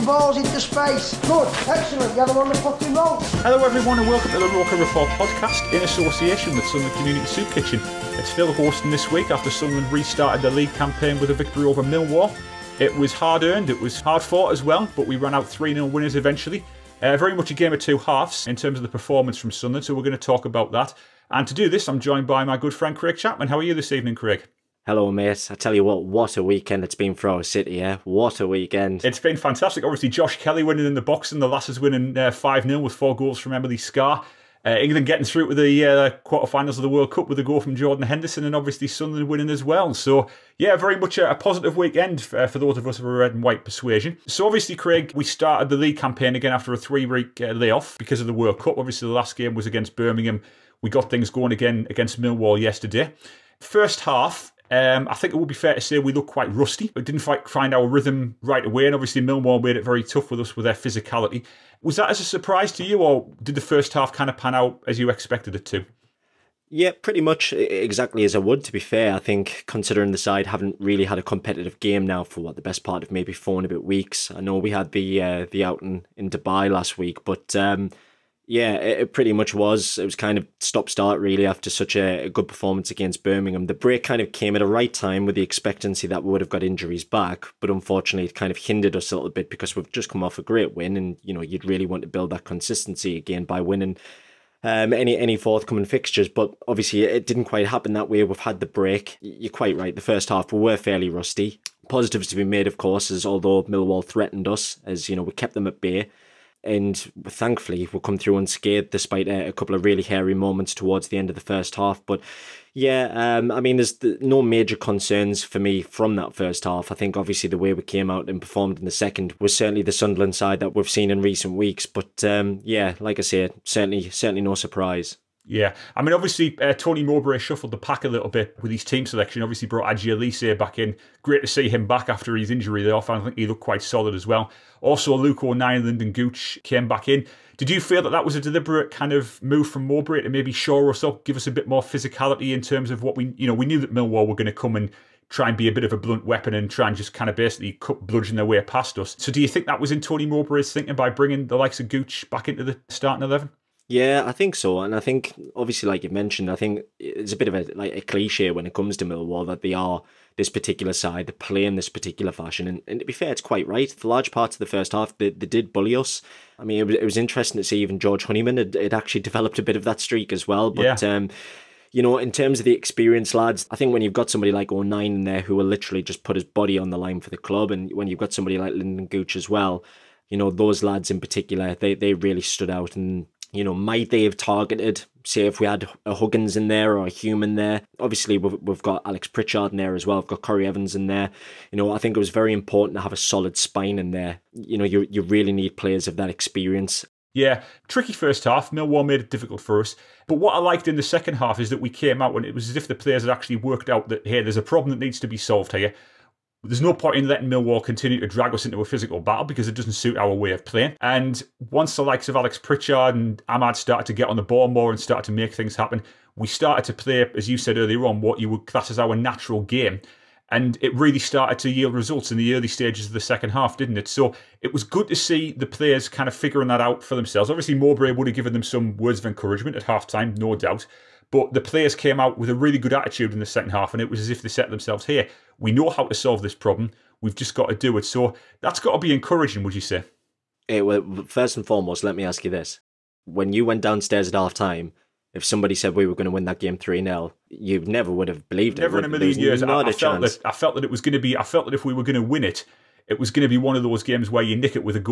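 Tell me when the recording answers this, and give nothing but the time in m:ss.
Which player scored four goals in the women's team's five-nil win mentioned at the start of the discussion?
0:33.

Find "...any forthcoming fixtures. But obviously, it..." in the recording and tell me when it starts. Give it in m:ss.
1:35.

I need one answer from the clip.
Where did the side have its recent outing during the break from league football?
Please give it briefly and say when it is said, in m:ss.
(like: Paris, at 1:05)
Dubai, at 1:16.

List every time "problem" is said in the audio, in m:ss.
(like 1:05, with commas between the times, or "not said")
3:24, 3:56.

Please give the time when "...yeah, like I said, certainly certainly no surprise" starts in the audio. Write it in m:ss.
2:02.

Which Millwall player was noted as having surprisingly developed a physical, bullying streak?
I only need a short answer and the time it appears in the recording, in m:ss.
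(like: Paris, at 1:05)
George Honeyman, at 2:47.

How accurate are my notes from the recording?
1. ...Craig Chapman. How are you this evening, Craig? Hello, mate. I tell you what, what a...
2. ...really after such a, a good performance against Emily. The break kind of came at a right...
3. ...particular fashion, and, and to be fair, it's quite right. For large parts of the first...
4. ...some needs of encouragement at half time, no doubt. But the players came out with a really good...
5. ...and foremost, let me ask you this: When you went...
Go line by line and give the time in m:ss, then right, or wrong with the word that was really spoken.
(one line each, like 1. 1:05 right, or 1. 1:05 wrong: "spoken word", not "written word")
1. 0:22 right
2. 1:21 wrong: "Birmingham", not "Emily"
3. 2:41 right
4. 3:48 wrong: "words", not "needs"
5. 4:01 right.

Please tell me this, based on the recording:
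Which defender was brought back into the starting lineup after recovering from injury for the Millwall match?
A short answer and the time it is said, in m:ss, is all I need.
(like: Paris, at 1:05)
Aji Alese, at 2:09.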